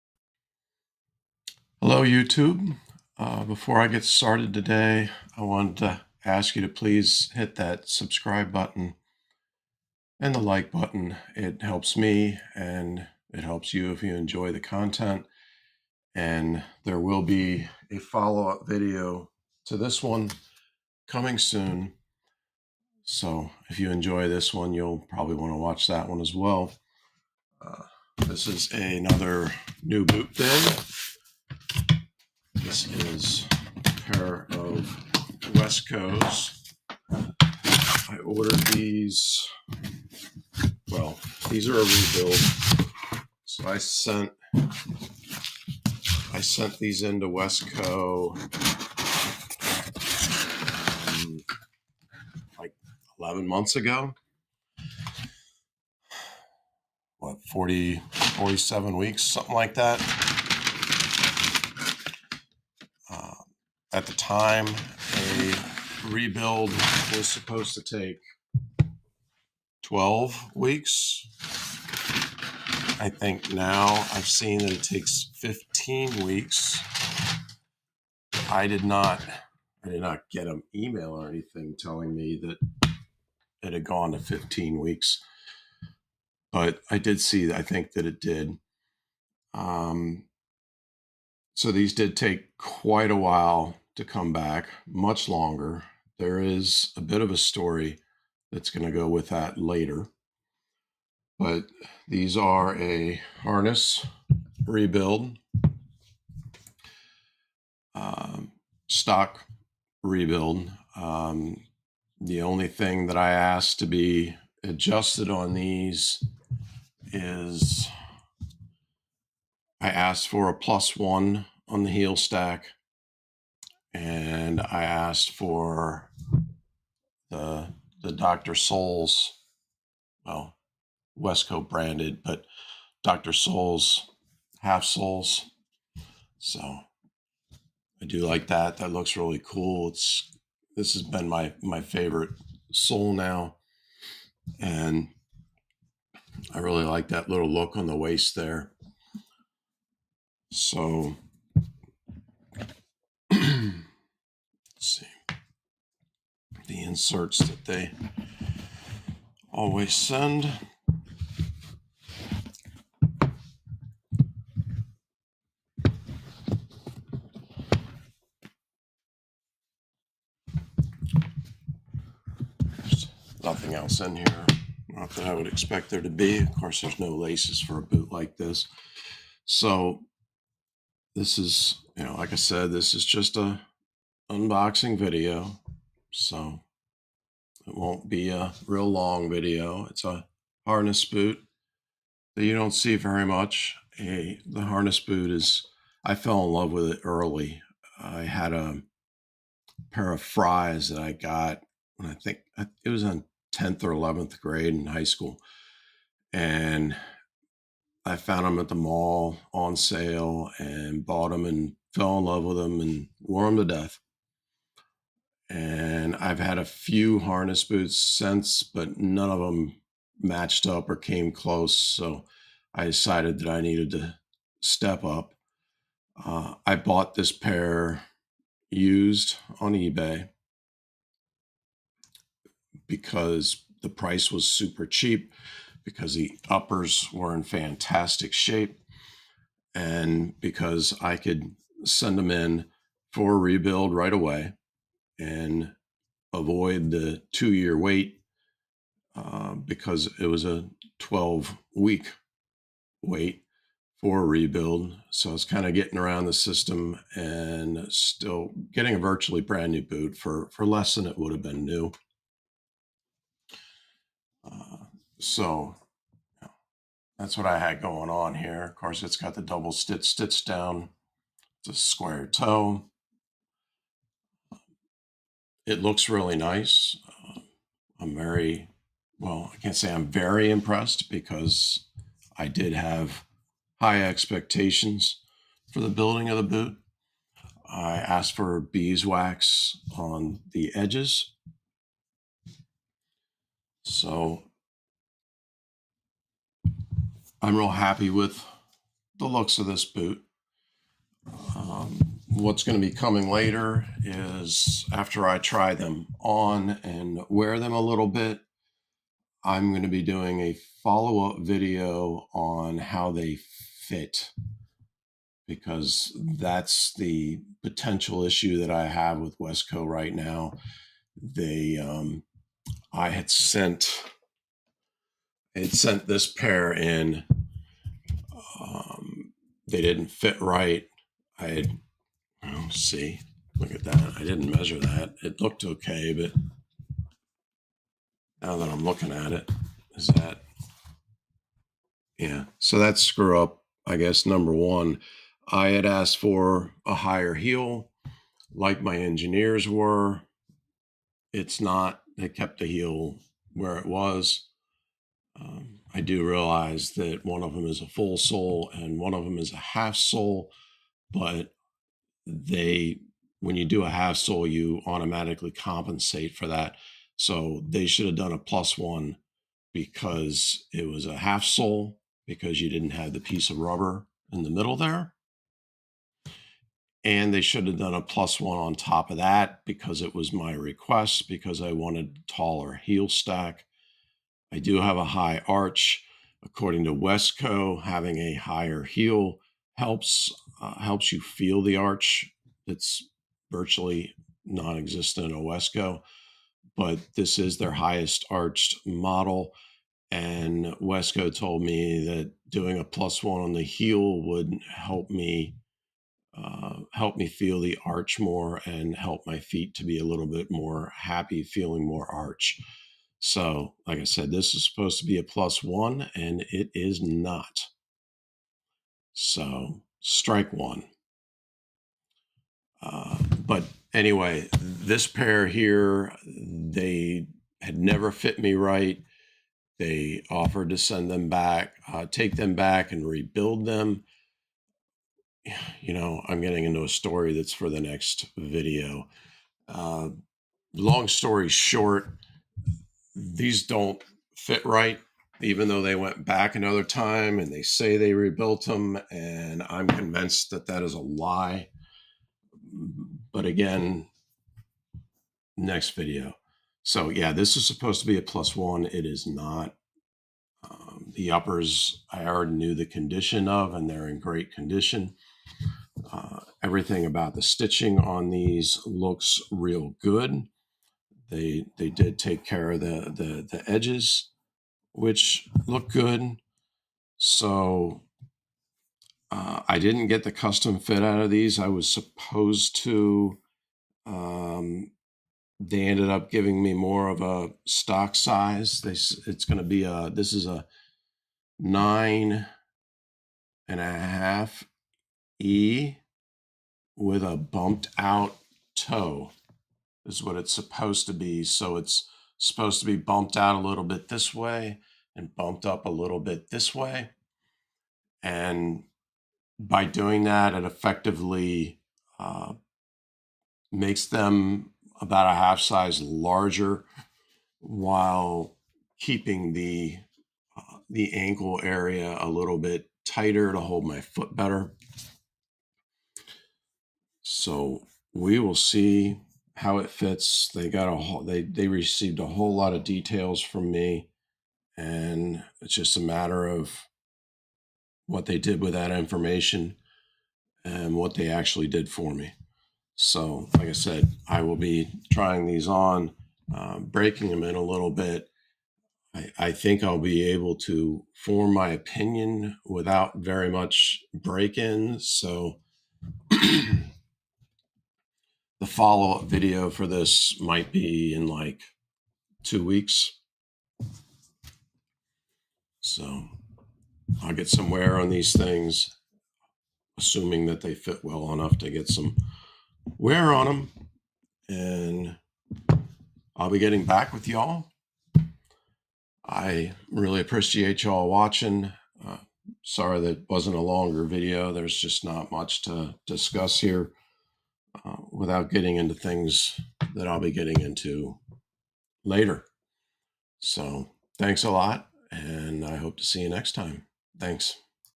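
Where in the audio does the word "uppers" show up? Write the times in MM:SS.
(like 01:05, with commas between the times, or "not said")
03:56, 07:41.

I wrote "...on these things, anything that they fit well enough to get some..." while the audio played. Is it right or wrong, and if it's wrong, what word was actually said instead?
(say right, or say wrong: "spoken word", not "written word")
wrong: "assuming", not "anything".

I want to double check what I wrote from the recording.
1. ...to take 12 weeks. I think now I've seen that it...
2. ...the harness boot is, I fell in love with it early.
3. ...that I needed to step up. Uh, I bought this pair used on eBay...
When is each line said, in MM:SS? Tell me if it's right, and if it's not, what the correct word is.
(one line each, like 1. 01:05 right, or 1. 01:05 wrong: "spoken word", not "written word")
1. 01:07 right
2. 03:14 right
3. 03:43 right.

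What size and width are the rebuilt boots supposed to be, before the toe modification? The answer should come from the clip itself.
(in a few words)
9.5 E.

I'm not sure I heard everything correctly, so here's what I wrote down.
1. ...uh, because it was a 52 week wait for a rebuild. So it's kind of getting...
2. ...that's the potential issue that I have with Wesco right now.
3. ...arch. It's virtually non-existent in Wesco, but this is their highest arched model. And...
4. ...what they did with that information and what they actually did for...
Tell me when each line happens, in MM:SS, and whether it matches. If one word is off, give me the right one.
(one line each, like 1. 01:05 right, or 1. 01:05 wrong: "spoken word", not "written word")
1. 04:09 wrong: "12", not "52"
2. 05:16 right
3. 06:31 right
4. 08:58 right.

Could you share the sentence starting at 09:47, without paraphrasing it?
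Uh, without getting into things that I'll be getting into later.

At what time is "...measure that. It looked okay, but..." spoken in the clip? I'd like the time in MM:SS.
05:34.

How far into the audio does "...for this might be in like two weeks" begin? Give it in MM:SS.
09:19.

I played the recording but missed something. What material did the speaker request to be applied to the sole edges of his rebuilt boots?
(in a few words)
beeswax.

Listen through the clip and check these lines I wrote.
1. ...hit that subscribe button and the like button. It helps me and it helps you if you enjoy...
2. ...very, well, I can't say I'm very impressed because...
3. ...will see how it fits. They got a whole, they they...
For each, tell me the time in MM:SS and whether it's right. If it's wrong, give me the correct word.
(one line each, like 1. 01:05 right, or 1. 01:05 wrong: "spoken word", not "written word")
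1. 00:07 right
2. 04:38 right
3. 08:48 right.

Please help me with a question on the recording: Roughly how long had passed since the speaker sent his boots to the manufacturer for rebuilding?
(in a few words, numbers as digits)
47 weeks.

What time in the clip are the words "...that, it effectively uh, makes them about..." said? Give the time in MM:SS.
08:30.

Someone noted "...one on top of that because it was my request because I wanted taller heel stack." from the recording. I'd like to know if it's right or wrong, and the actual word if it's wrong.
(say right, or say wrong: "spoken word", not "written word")
right.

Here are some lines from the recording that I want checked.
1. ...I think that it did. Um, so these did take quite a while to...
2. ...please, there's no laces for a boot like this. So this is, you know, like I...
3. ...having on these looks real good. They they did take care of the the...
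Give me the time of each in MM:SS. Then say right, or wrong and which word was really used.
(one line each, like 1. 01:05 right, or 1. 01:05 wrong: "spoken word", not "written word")
1. 01:27 right
2. 02:56 wrong: "course", not "please"
3. 07:47 wrong: "stitching", not "having".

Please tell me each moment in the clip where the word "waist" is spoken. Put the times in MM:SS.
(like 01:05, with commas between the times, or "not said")
02:27.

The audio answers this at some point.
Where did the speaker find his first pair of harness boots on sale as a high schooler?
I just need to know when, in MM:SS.
03:28.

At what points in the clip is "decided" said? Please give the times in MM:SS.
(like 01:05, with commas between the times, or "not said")
03:42.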